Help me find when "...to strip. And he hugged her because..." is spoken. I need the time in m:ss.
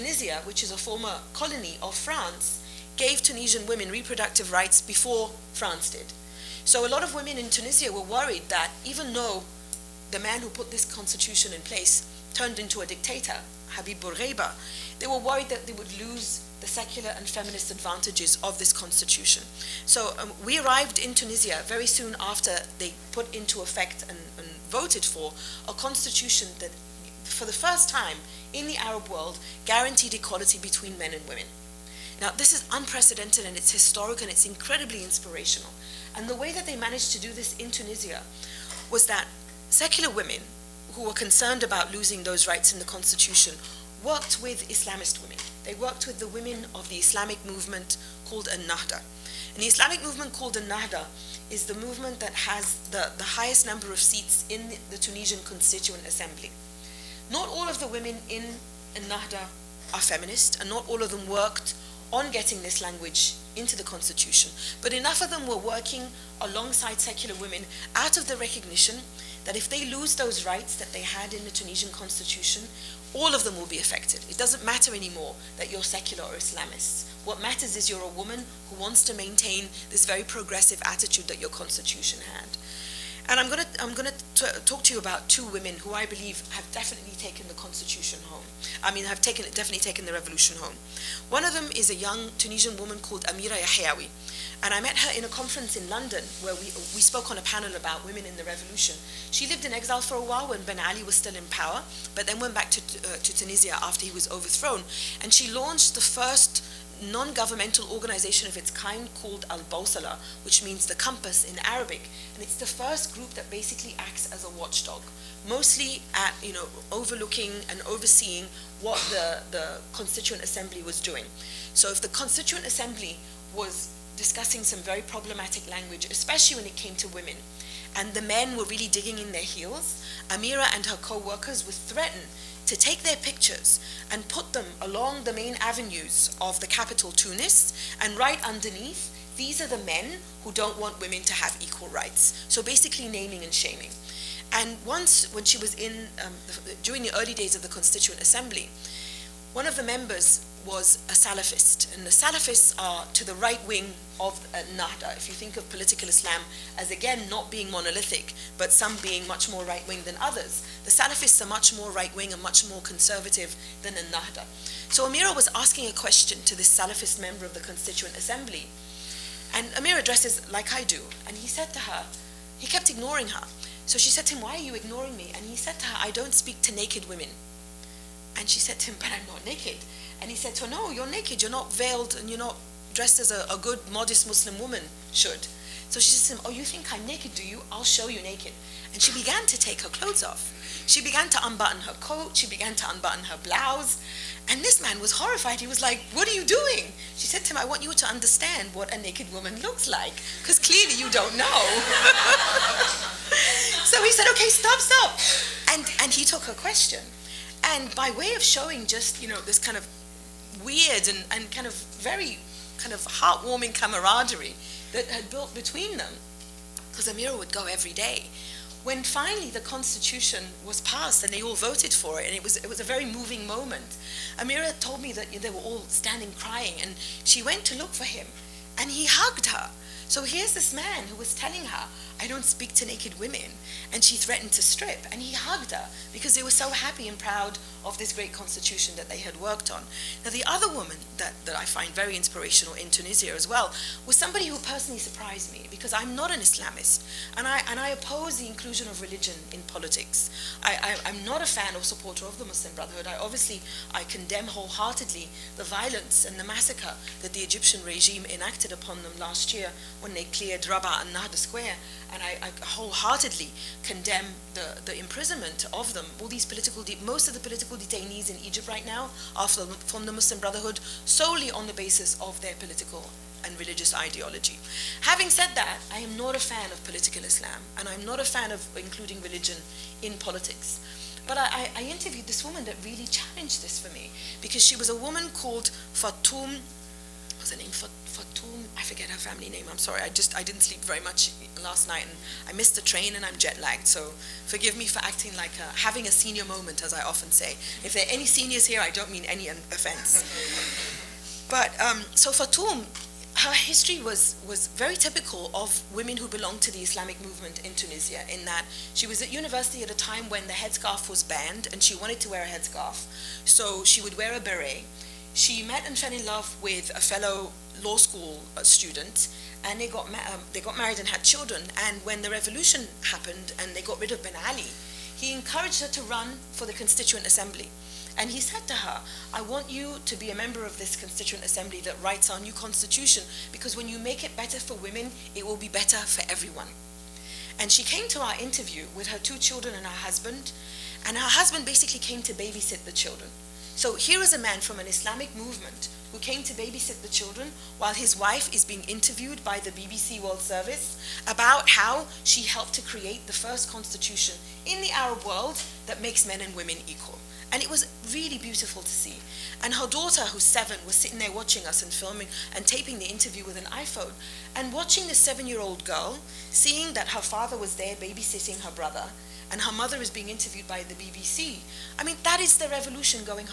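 3:54.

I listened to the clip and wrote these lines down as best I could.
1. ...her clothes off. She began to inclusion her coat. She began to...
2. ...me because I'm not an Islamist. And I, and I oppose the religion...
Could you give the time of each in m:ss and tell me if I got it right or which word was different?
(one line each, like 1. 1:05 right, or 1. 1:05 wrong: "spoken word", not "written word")
1. 3:09 wrong: "unbutton", not "inclusion"
2. 4:05 wrong: "inclusion", not "religion".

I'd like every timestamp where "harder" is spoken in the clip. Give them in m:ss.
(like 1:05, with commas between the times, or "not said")
not said.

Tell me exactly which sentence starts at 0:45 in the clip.
They worked with the women of the Islamic movement called An Nahda.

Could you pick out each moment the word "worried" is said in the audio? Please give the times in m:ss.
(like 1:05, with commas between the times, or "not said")
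0:08, 0:15.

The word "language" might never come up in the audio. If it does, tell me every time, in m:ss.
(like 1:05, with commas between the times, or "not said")
1:02, 2:05.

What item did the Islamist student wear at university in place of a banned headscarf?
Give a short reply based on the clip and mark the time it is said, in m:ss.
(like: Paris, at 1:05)
A beret, at 5:14.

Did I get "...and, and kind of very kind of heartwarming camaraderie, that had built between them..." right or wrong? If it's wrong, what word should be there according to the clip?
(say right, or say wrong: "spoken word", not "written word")
right.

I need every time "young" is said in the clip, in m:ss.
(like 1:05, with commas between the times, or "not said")
1:31.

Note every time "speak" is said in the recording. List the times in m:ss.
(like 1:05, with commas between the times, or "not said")
2:56, 3:52.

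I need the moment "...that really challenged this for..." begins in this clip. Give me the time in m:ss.
4:42.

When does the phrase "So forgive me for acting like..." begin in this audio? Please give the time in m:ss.
4:53.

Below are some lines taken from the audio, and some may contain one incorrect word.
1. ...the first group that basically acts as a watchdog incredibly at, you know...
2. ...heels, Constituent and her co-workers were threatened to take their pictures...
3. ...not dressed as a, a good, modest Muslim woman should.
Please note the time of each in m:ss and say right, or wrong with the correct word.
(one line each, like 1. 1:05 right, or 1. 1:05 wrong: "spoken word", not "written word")
1. 1:52 wrong: "mostly", not "incredibly"
2. 2:09 wrong: "Amira", not "Constituent"
3. 3:02 right.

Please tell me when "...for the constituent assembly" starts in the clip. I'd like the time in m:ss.
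5:26.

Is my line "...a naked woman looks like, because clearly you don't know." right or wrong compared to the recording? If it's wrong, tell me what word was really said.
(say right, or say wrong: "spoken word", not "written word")
right.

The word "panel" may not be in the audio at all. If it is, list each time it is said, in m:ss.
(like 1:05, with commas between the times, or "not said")
1:37.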